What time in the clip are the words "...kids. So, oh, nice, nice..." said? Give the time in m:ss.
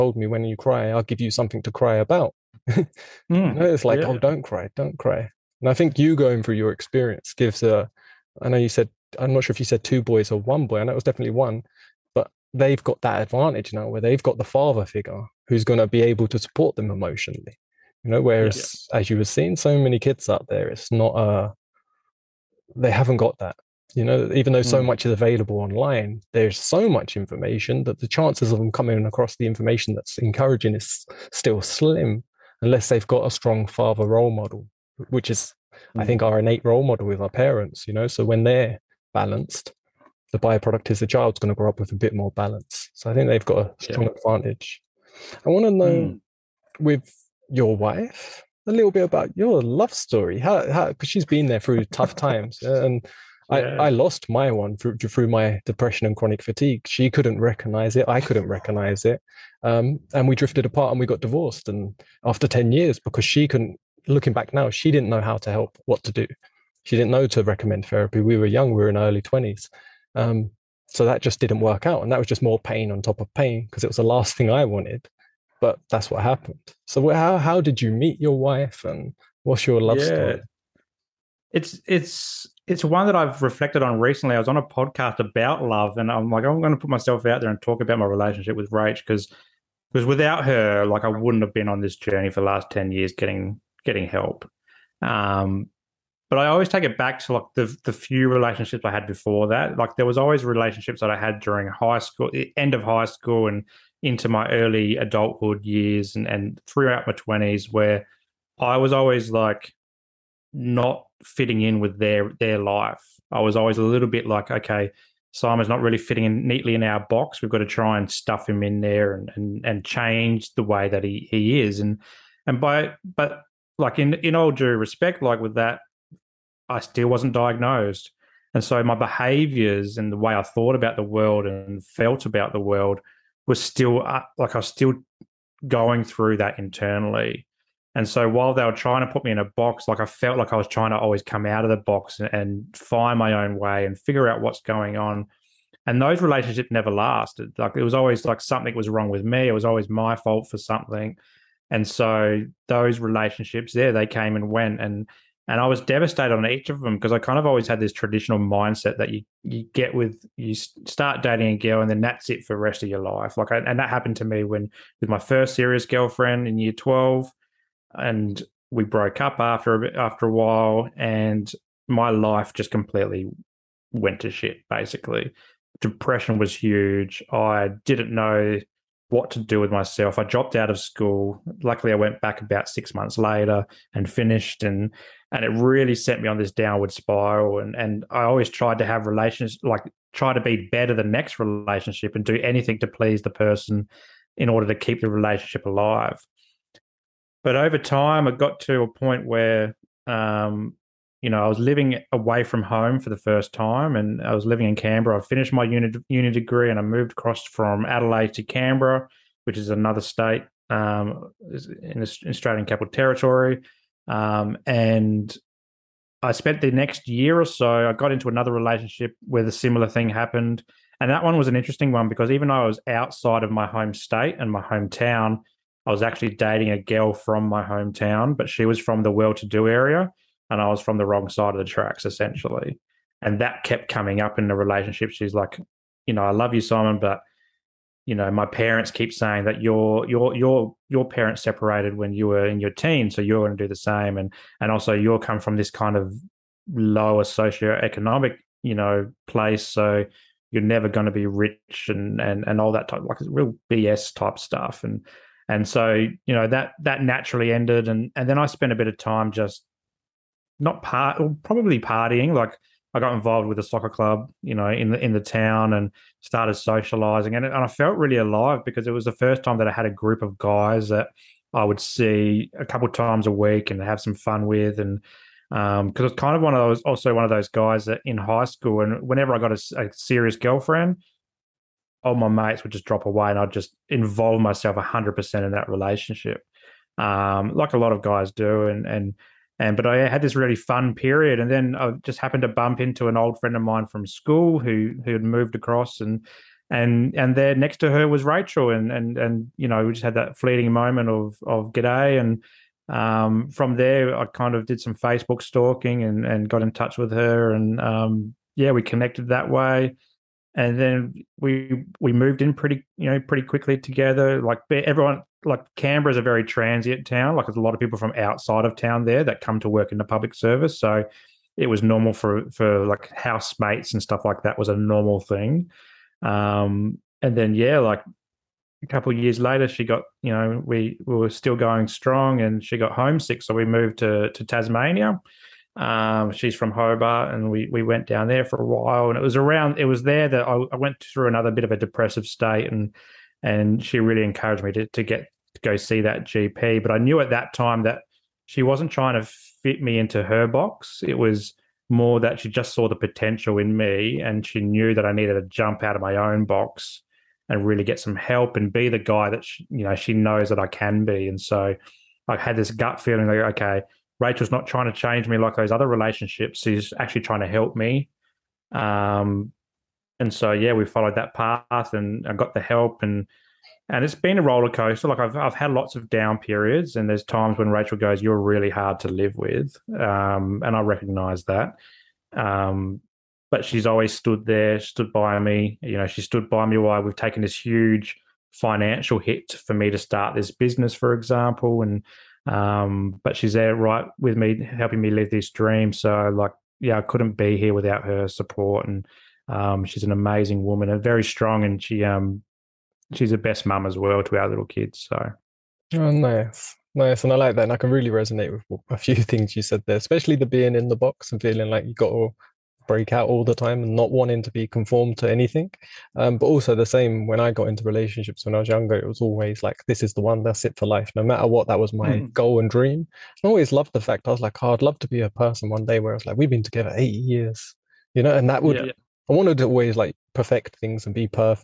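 6:44.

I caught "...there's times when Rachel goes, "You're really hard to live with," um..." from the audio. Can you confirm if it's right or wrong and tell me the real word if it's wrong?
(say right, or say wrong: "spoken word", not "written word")
right.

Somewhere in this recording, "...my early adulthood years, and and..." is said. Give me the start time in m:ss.
1:44.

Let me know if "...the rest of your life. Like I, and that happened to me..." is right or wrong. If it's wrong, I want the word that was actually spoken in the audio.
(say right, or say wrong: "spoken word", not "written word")
right.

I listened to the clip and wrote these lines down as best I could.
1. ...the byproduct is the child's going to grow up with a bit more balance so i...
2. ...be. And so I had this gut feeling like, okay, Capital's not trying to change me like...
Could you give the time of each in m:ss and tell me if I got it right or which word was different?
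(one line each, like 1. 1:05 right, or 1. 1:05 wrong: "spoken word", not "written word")
1. 0:40 right
2. 6:01 wrong: "Rachel", not "Capital".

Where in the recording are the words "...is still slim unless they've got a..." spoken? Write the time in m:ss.
0:30.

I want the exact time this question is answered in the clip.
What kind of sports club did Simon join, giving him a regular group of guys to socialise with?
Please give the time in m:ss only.
4:23.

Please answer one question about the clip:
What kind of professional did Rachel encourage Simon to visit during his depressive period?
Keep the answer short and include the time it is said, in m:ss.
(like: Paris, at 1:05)
GP, at 5:46.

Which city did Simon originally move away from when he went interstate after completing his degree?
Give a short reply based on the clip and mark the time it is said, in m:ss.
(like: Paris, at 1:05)
Adelaide, at 3:27.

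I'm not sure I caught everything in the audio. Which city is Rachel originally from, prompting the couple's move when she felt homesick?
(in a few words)
Hobart.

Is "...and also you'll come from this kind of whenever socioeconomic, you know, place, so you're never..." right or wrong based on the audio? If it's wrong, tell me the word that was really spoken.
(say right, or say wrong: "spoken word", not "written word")
wrong: "lower", not "whenever".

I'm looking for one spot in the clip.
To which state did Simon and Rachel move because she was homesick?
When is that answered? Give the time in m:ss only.
5:34.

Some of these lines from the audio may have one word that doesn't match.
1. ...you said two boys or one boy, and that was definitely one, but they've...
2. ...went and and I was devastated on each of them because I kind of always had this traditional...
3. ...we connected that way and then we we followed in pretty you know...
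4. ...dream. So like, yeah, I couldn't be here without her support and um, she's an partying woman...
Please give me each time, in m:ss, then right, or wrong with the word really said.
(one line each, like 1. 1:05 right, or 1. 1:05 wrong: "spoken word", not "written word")
1. 0:09 right
2. 2:34 right
3. 5:08 wrong: "moved", not "followed"
4. 6:35 wrong: "amazing", not "partying".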